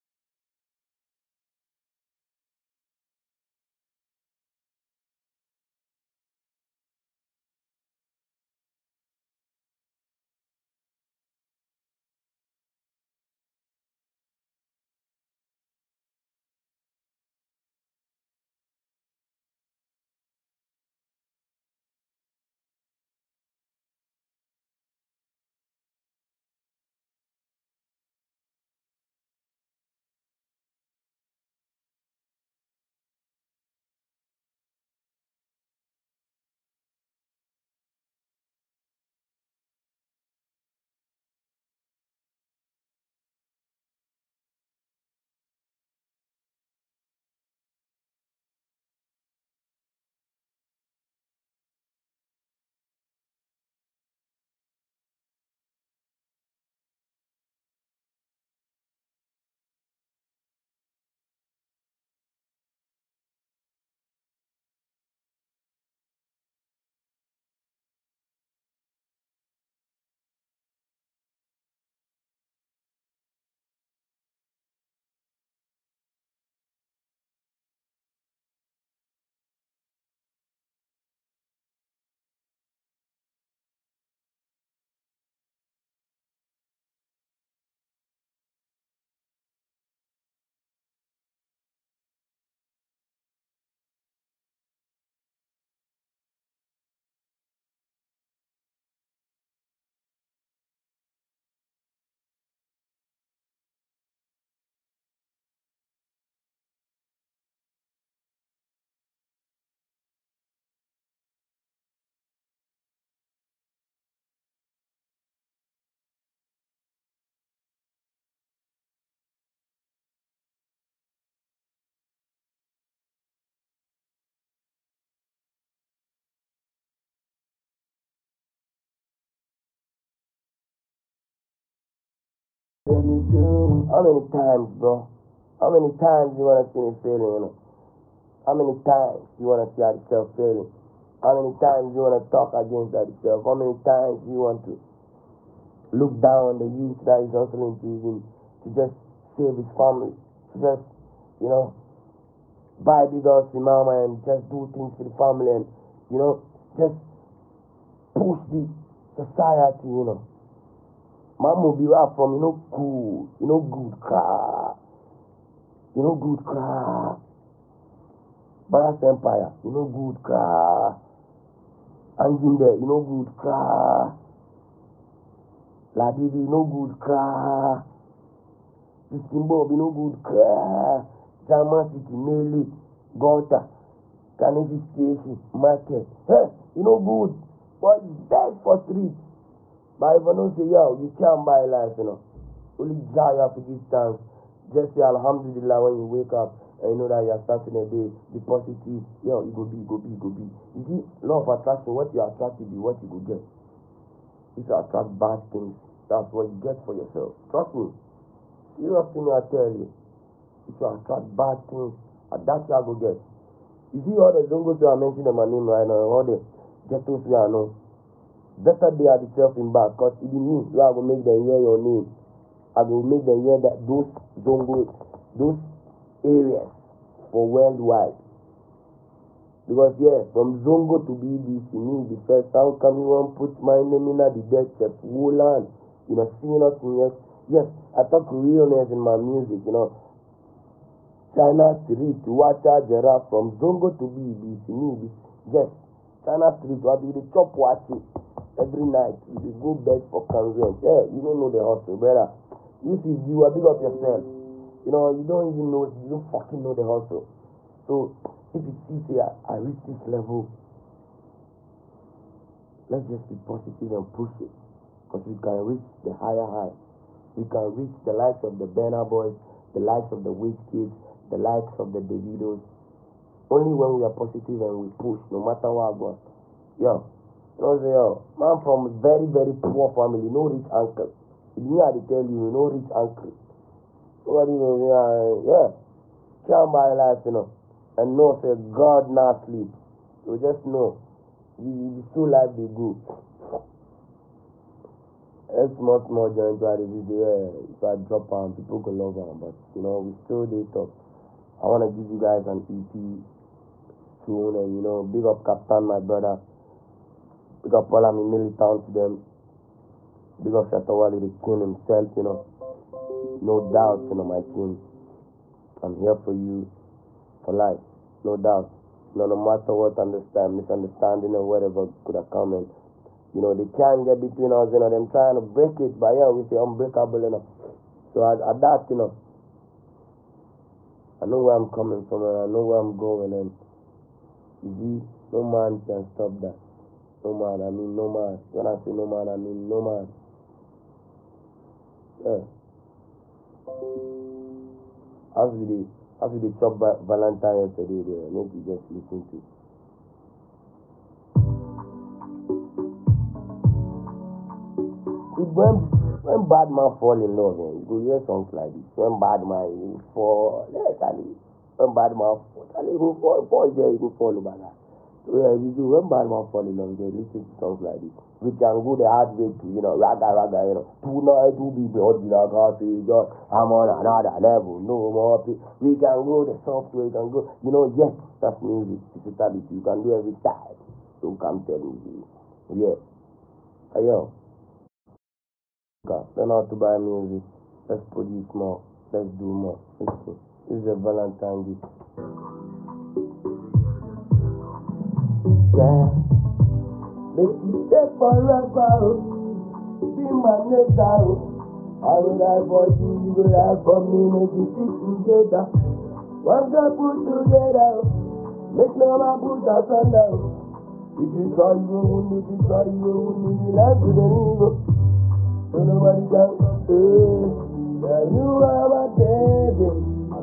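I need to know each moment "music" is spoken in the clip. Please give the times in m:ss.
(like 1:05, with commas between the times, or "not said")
3:59, 6:18, 6:26.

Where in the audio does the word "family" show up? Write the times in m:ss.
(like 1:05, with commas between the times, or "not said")
2:29, 2:35, 4:39.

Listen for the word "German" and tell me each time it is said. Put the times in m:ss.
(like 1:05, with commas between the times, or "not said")
3:01.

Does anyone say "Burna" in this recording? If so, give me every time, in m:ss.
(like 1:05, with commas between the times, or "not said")
4:28.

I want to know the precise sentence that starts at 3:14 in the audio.
Just say Alhamdulillah when you wake up and you know that you are starting a day.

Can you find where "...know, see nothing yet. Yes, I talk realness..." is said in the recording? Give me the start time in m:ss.
3:56.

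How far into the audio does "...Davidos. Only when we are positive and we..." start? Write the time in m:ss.
4:31.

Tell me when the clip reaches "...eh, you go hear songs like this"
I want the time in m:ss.
5:57.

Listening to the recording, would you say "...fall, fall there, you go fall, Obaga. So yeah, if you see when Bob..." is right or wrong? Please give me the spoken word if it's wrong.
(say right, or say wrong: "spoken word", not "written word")
wrong: "Badman", not "Bob".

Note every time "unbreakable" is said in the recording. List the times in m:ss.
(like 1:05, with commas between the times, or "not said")
5:26.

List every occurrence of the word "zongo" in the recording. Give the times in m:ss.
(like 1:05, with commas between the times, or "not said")
3:34, 3:44, 3:50, 4:03.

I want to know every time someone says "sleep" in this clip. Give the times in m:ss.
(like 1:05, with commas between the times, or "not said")
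4:49.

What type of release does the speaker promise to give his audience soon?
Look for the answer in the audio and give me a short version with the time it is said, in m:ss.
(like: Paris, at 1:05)
EP, at 5:02.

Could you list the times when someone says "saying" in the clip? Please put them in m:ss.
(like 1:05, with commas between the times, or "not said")
4:37.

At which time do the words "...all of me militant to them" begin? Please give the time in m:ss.
5:07.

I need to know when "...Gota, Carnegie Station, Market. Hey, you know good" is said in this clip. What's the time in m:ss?
3:03.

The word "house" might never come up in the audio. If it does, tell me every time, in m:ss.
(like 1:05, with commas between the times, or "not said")
2:33.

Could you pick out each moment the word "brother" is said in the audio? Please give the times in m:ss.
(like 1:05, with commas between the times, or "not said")
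4:11, 5:05.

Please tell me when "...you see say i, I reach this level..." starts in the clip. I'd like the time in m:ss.
4:18.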